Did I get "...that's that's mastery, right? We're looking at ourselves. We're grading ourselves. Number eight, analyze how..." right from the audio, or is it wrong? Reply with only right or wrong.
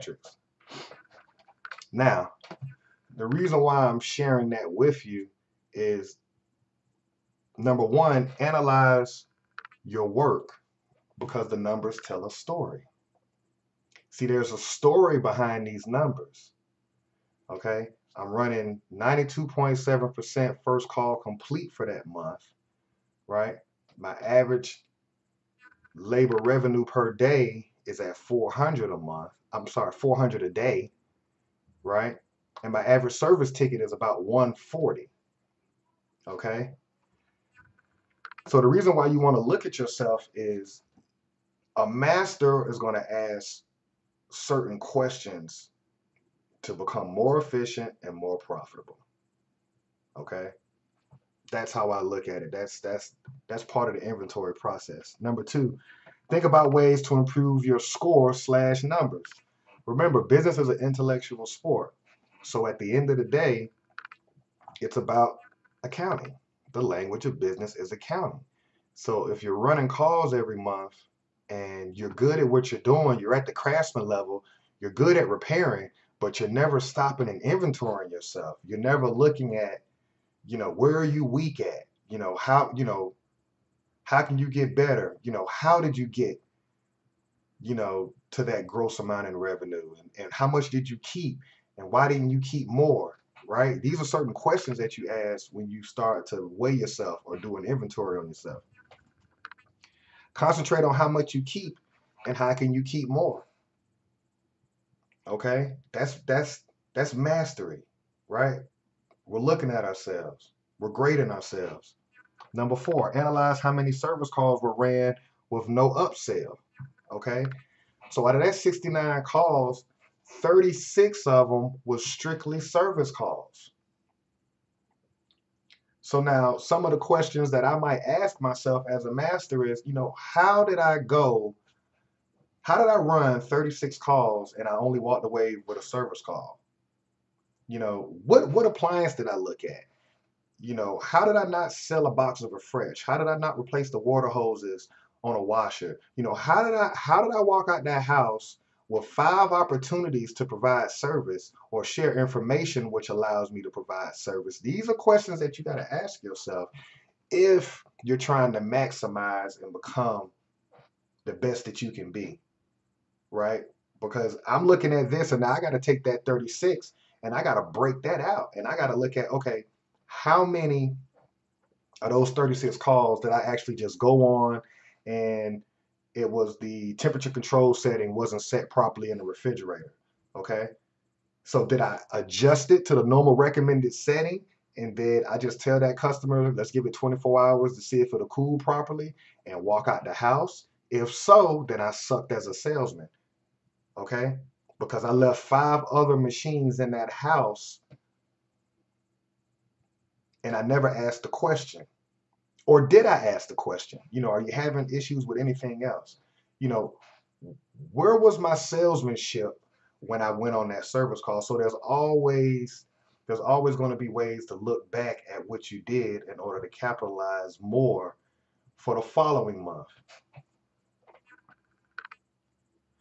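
wrong.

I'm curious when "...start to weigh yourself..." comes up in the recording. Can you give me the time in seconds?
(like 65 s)
95 s.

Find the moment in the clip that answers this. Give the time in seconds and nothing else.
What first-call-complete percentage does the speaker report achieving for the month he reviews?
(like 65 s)
18 s.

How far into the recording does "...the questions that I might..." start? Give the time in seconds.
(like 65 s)
126 s.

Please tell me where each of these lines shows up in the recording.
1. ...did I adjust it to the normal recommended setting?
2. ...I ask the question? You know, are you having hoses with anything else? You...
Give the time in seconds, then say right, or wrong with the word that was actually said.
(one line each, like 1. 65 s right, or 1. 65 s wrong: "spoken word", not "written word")
1. 181 s right
2. 203 s wrong: "issues", not "hoses".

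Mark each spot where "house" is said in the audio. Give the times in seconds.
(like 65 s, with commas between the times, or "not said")
148 s, 190 s, 197 s.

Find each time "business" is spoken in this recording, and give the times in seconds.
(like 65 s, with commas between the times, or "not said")
60 s, 67 s.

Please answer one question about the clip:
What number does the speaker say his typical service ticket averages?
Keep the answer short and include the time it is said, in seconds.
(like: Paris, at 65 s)
140, at 34 s.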